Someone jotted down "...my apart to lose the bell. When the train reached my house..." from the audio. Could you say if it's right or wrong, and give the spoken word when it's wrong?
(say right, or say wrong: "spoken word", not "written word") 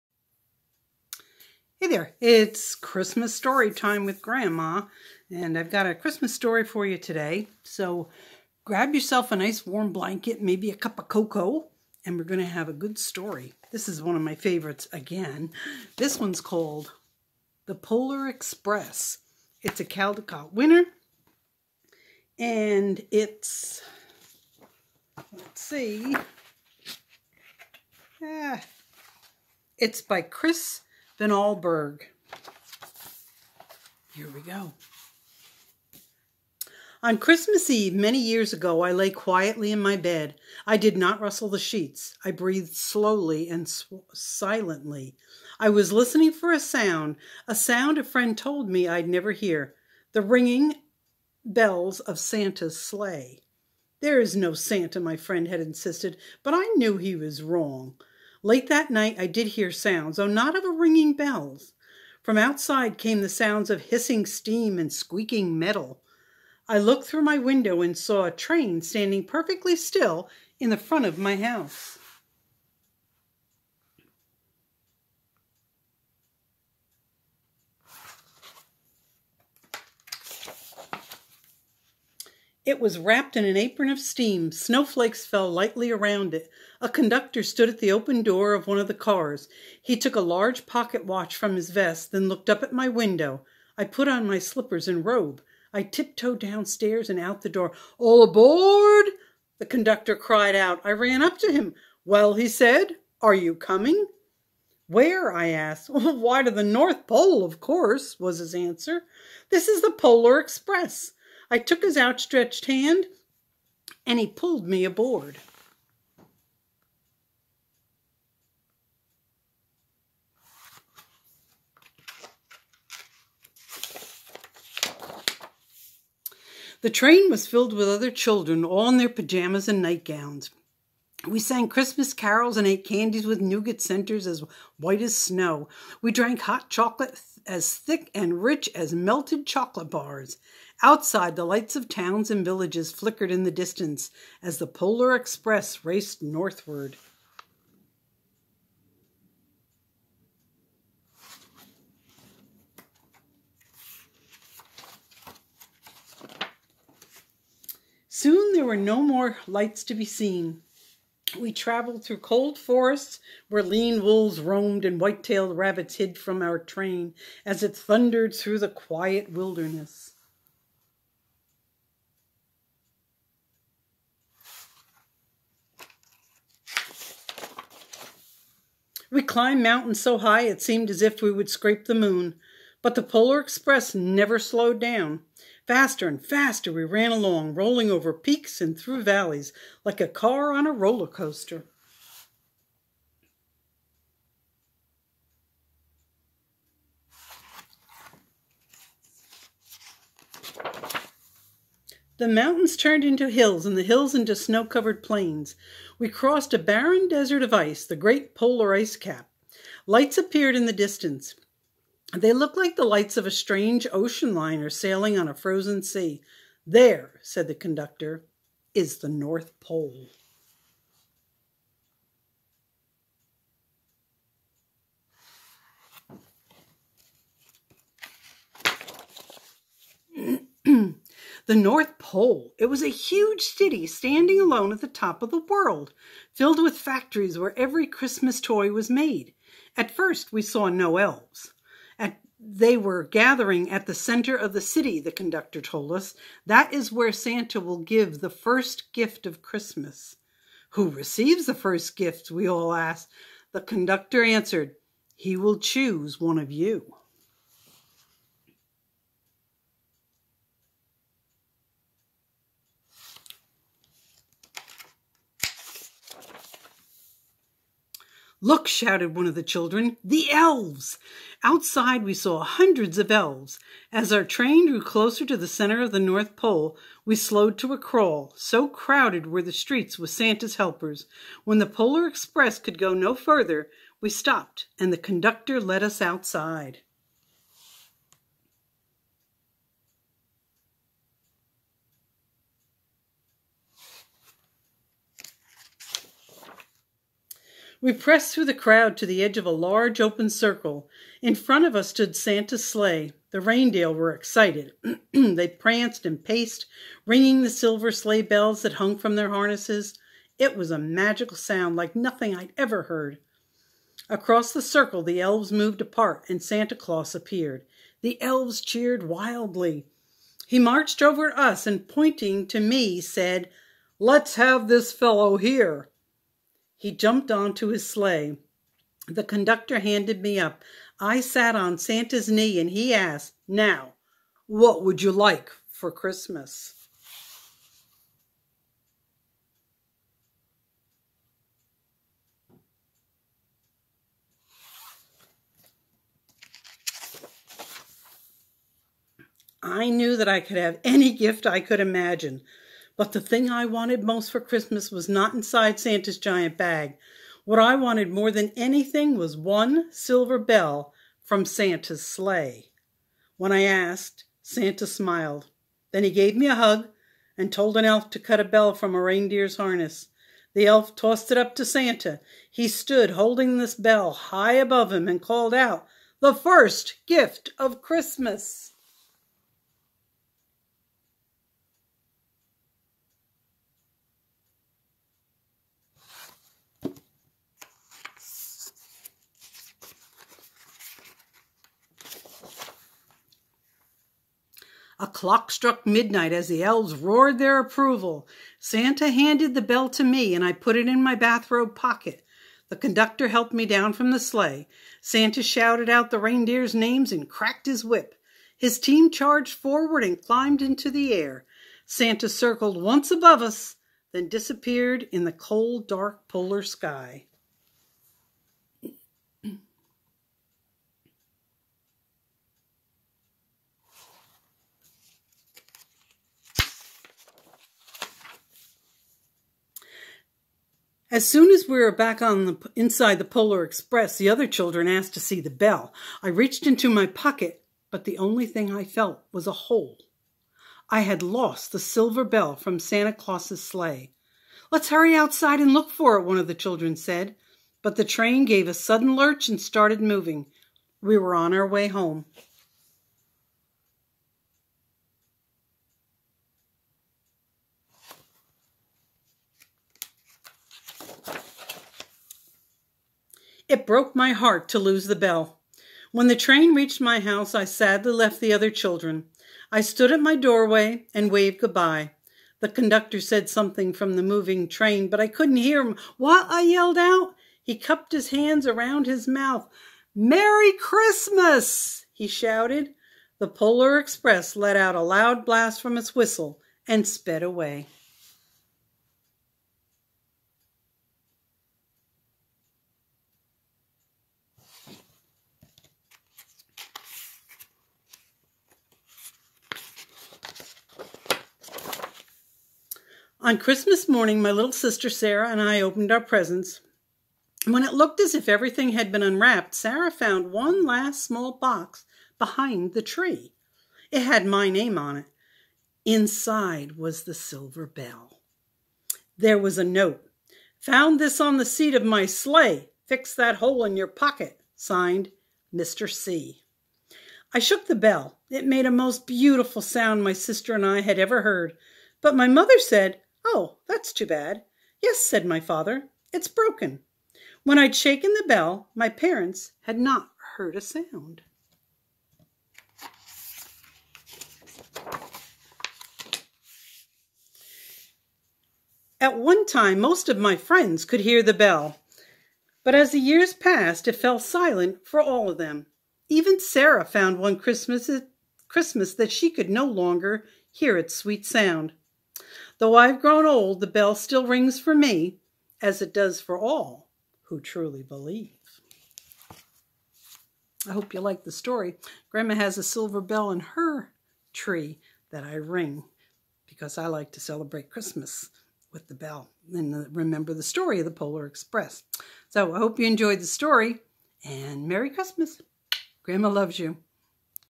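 wrong: "heart", not "apart".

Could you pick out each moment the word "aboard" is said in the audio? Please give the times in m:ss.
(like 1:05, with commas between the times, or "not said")
1:38, 1:54.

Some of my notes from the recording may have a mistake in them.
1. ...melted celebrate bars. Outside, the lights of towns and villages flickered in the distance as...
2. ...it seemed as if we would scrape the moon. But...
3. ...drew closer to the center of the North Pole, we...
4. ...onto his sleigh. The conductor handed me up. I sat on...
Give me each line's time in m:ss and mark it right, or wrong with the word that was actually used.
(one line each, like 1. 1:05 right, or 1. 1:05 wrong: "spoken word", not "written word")
1. 2:18 wrong: "chocolate", not "celebrate"
2. 3:00 right
3. 4:34 right
4. 5:27 right.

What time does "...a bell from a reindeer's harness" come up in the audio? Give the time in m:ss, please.
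6:08.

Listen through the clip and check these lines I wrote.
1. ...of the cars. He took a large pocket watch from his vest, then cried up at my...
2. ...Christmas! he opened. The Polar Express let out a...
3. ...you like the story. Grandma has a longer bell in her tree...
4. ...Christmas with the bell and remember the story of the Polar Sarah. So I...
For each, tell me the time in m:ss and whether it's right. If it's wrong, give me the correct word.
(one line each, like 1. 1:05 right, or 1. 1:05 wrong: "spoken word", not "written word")
1. 1:28 wrong: "looked", not "cried"
2. 8:00 wrong: "shouted", not "opened"
3. 9:31 wrong: "silver", not "longer"
4. 9:37 wrong: "Express", not "Sarah".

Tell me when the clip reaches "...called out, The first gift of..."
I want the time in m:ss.
6:15.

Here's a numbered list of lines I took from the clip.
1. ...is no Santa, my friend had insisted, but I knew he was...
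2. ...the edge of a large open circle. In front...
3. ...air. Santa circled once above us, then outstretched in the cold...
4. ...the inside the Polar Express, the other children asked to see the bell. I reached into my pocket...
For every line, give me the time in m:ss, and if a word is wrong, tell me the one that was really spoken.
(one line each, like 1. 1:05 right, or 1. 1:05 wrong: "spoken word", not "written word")
1. 0:54 right
2. 4:59 right
3. 6:51 wrong: "disappeared", not "outstretched"
4. 7:12 right.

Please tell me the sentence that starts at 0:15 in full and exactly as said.
This one's called The Polar Express.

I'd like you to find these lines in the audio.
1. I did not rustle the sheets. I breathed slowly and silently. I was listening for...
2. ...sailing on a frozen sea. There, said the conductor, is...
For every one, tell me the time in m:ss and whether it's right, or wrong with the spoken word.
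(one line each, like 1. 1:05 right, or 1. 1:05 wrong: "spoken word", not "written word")
1. 0:40 right
2. 3:34 right.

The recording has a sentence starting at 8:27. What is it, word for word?
When it looked as if everything had been unwrapped, Sarah found one last small box behind the tree.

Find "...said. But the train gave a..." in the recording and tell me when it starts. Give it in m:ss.
7:26.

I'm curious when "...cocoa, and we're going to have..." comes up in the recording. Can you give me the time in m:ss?
0:11.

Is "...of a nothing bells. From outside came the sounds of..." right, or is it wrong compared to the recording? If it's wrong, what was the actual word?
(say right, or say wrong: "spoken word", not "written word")
wrong: "ringing", not "nothing".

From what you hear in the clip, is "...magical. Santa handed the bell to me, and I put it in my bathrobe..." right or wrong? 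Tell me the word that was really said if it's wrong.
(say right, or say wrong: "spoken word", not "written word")
wrong: "approval", not "magical".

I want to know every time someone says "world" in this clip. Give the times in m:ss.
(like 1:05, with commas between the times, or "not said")
3:55.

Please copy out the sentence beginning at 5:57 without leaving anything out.
What I wanted more than anything was one silver bell from Santa's sleigh.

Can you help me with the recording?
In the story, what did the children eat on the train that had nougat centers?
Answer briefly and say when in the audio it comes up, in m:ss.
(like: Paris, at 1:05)
candies, at 2:12.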